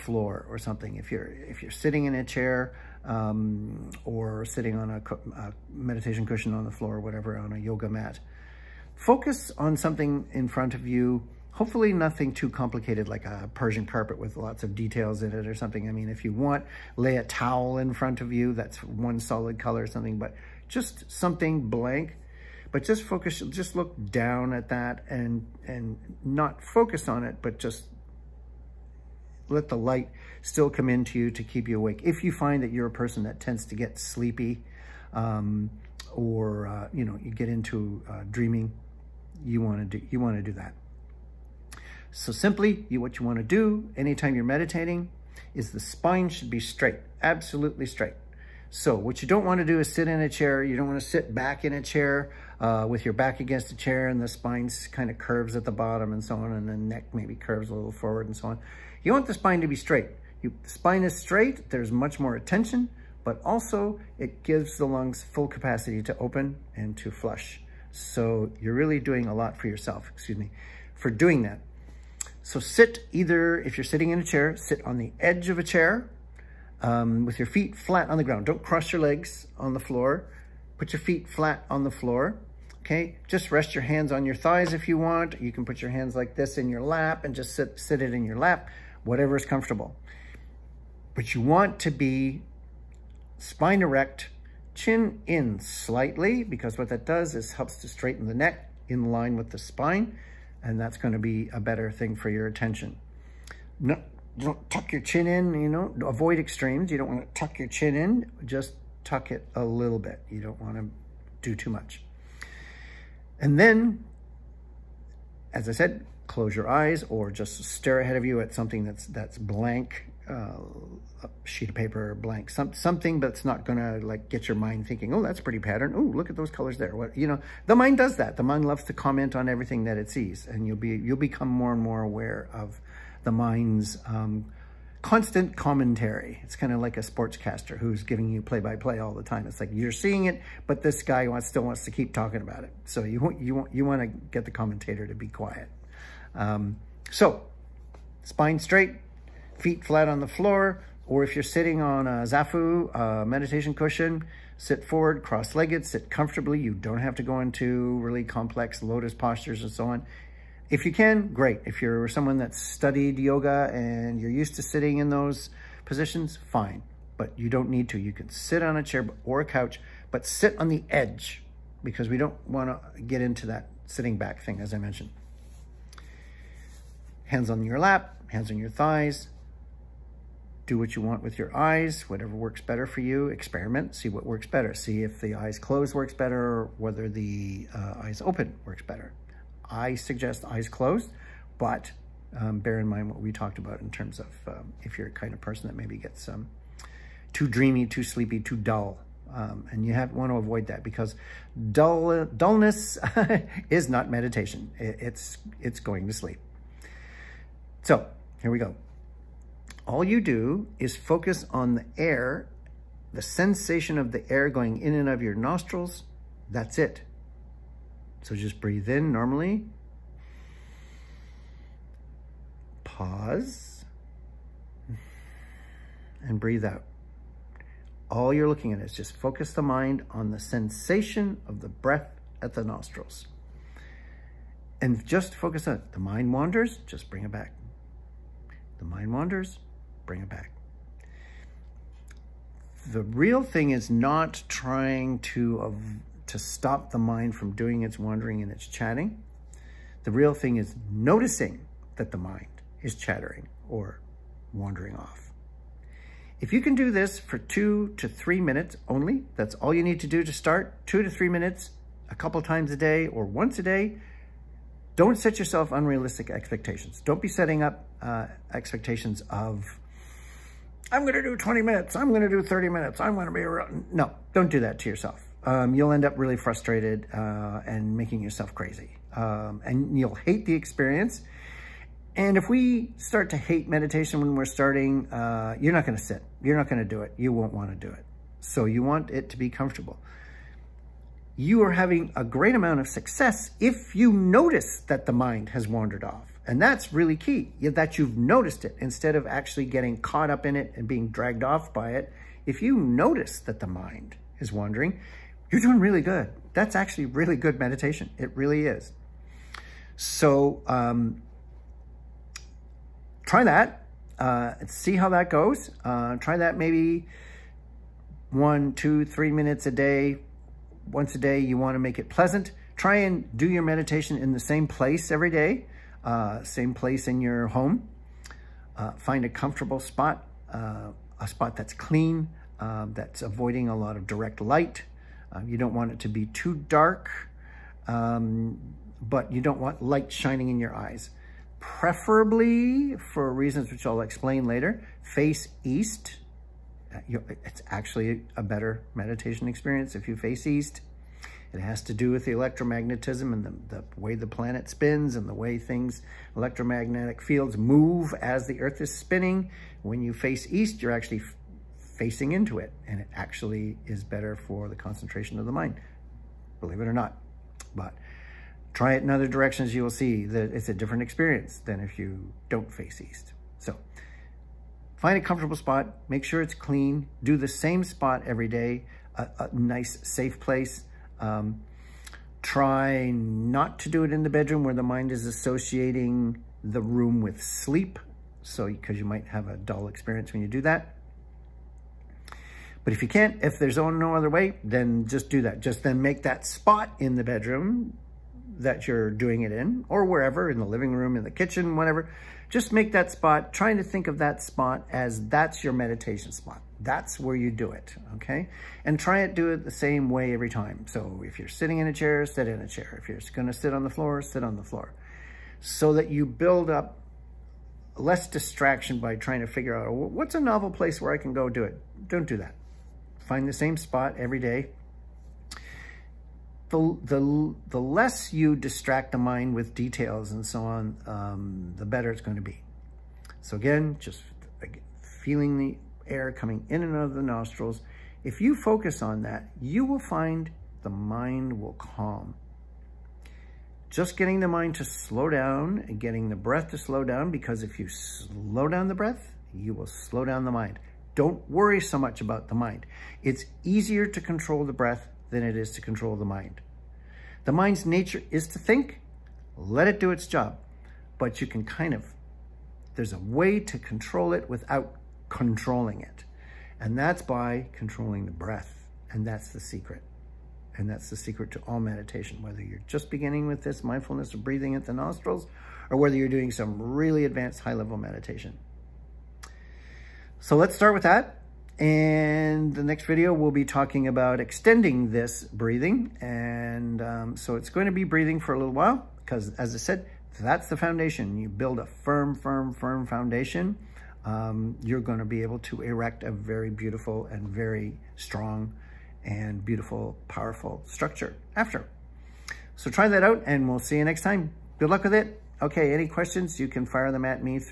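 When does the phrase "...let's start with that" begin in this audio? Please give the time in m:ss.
8:00.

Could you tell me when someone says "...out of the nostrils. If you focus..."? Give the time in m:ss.
7:16.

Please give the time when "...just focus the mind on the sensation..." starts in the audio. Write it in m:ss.
3:48.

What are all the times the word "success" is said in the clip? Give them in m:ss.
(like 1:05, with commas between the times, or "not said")
4:52.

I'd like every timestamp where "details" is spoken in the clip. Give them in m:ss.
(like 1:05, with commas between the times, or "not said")
0:14, 7:09.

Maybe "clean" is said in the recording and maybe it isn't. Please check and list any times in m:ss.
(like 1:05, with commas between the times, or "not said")
5:31, 6:16.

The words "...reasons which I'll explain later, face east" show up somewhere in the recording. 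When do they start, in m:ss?
5:43.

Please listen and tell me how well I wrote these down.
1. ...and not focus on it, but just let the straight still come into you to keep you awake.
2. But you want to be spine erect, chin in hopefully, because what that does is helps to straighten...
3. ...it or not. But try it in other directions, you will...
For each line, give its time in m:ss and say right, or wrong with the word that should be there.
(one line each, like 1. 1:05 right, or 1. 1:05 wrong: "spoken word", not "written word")
1. 0:25 wrong: "light", not "straight"
2. 1:31 wrong: "slightly", not "hopefully"
3. 6:06 right.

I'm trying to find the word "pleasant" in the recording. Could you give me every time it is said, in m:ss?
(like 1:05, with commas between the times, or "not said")
5:22.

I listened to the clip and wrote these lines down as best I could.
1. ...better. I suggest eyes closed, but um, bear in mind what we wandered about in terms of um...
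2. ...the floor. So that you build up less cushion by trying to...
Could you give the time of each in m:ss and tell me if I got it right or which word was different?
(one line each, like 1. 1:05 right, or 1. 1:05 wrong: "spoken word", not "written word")
1. 3:08 wrong: "talked", not "wandered"
2. 6:54 wrong: "distraction", not "cushion".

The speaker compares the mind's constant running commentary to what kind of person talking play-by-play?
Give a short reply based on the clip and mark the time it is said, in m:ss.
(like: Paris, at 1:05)
Sportscaster, at 2:17.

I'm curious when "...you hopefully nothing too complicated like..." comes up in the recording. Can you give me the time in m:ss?
0:10.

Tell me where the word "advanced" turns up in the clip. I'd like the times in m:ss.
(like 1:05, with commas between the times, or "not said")
7:57.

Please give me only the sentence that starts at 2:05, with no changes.
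Oh, look at those colors there.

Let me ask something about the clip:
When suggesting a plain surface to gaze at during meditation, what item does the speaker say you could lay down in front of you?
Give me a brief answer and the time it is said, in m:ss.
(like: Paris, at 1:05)
A towel, at 0:17.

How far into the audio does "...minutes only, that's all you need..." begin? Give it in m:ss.
4:18.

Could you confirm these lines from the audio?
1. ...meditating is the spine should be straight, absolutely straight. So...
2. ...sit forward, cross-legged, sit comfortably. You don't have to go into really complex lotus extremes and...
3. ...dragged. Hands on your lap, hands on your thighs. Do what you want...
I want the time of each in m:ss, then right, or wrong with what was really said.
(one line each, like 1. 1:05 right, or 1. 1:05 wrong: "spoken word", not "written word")
1. 0:44 right
2. 2:34 wrong: "postures", not "extremes"
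3. 2:54 wrong: "mentioned", not "dragged".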